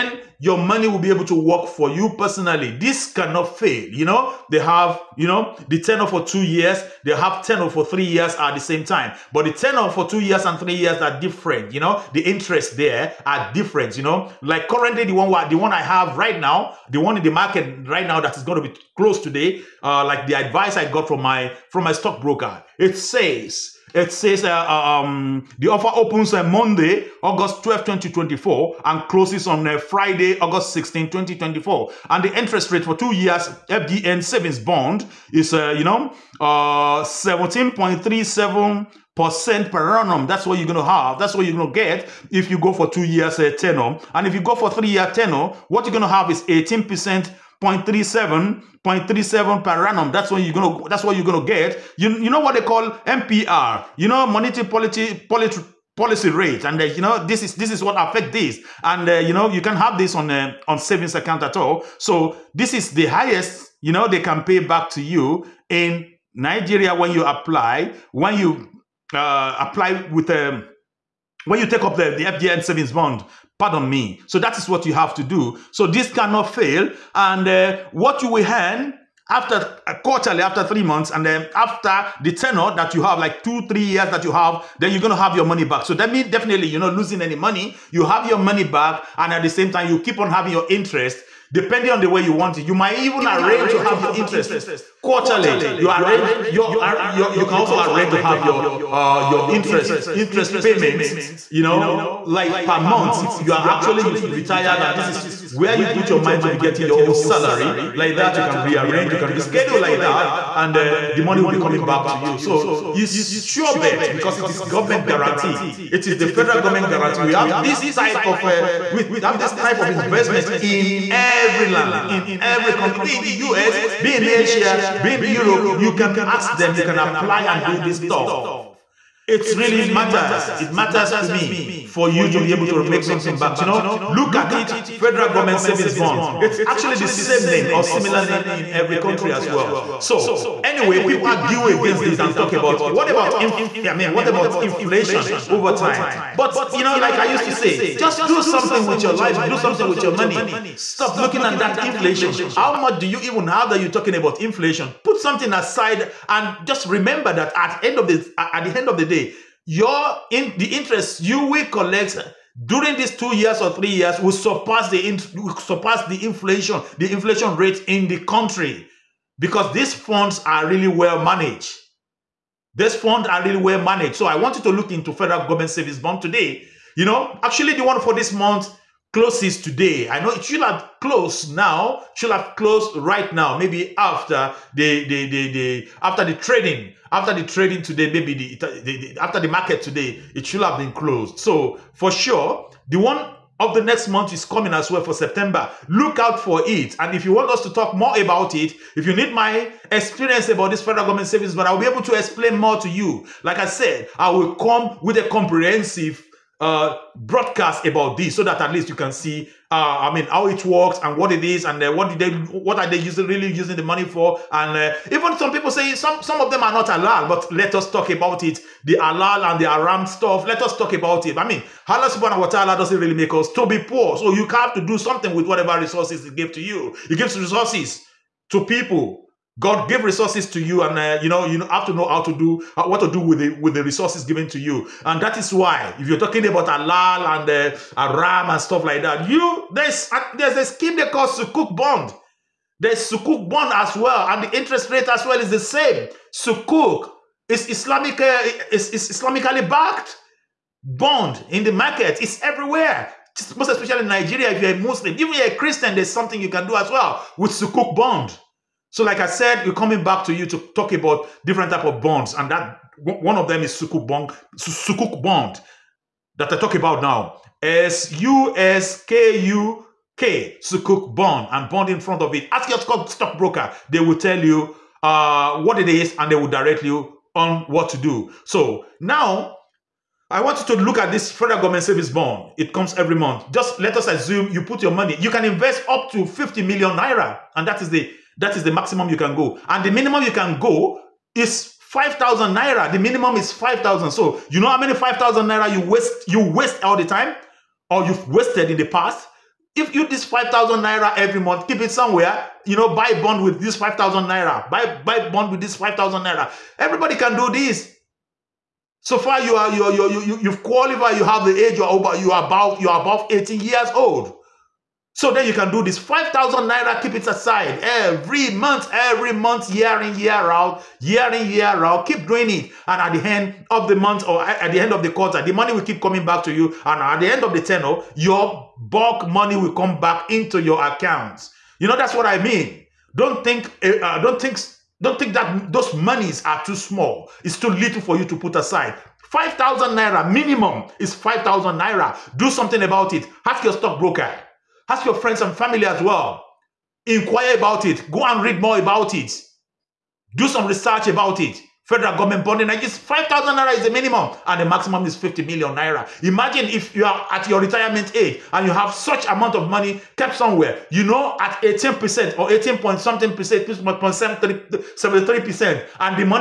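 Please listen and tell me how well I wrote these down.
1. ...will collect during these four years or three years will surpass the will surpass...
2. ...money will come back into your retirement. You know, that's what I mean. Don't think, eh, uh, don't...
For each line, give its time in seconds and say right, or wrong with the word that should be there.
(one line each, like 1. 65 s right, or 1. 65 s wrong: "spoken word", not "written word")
1. 161 s wrong: "two", not "four"
2. 329 s wrong: "account", not "retirement".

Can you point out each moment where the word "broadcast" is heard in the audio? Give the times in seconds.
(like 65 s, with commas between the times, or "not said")
207 s.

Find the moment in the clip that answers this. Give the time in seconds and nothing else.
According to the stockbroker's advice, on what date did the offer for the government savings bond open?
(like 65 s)
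26 s.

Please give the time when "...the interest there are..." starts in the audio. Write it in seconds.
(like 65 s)
12 s.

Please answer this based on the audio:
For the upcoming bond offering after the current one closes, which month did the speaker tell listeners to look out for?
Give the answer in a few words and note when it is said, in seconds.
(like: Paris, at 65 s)
September, at 195 s.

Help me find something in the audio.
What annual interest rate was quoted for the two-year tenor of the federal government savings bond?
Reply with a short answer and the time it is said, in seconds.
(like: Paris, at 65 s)
17.37%, at 36 s.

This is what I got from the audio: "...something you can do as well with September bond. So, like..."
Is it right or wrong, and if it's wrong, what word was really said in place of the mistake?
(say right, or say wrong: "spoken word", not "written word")
wrong: "Sukuk", not "September".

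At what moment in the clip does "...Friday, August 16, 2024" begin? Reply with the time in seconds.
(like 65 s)
29 s.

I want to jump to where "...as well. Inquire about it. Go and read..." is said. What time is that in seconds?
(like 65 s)
345 s.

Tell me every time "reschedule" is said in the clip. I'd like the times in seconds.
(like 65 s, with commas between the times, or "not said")
109 s.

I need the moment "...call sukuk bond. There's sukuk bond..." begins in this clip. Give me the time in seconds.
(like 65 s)
241 s.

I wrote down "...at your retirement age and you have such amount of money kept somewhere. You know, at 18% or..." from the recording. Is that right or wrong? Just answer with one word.
right.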